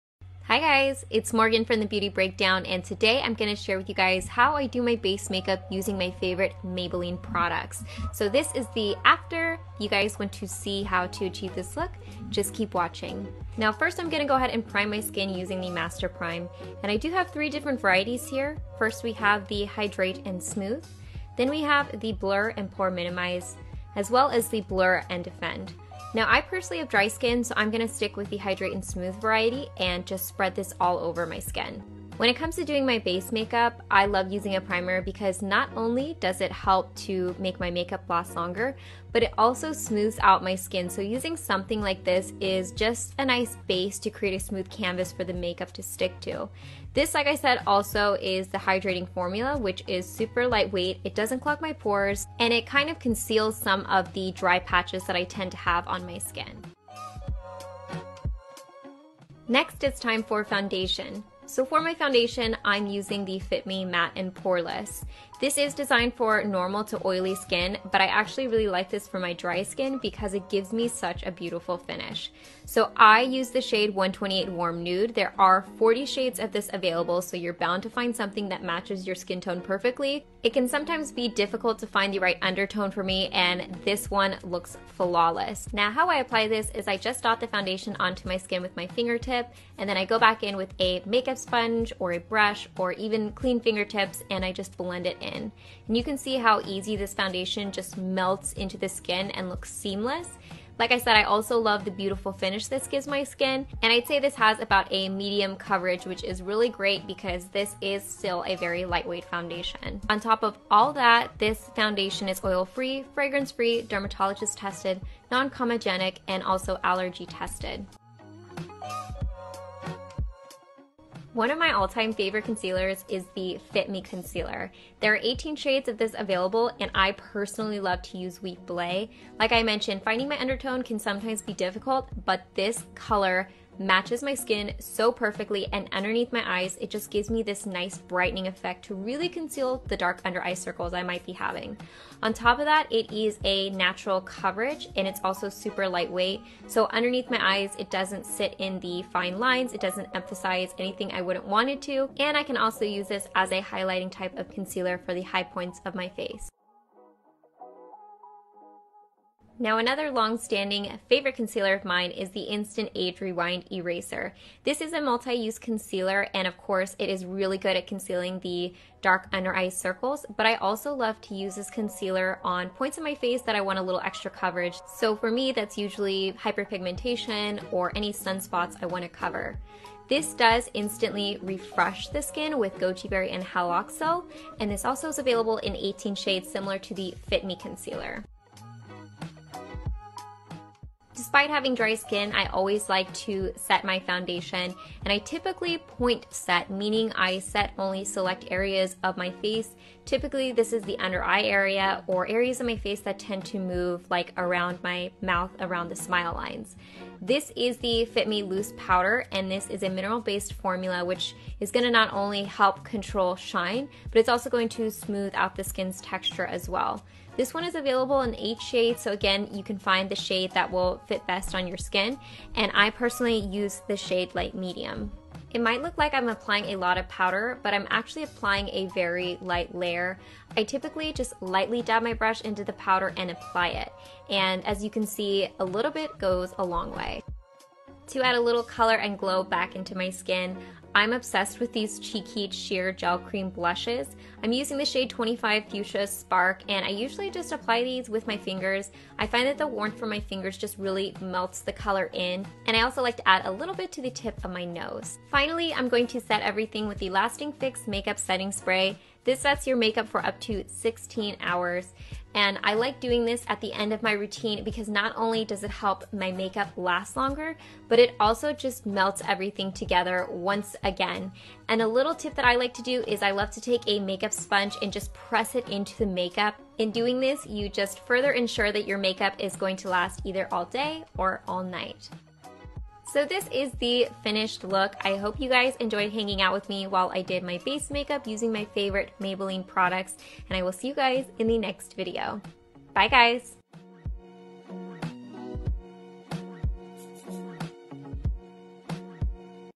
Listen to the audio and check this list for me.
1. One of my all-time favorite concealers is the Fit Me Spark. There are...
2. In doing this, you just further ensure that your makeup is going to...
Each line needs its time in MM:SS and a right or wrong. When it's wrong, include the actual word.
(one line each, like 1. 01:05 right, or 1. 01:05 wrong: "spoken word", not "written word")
1. 02:01 wrong: "Concealer", not "Spark"
2. 04:36 right.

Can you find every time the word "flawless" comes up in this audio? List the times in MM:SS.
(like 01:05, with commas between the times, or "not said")
01:24.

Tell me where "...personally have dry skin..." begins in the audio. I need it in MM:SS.
00:26.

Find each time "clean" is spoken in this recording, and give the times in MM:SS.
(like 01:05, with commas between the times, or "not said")
01:33.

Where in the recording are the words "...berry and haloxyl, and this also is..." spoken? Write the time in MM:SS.
03:03.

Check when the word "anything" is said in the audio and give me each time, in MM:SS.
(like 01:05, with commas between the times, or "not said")
02:30.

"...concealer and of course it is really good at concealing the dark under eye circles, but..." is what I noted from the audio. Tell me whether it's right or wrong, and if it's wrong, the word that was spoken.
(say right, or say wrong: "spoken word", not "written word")
right.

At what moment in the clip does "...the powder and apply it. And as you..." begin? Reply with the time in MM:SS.
03:52.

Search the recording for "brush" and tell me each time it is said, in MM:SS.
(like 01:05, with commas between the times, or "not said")
01:32, 03:52.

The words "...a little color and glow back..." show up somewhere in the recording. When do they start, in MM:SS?
03:58.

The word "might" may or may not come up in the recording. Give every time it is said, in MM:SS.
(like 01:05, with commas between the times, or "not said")
02:21, 03:45.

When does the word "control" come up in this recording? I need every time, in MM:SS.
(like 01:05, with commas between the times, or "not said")
03:32.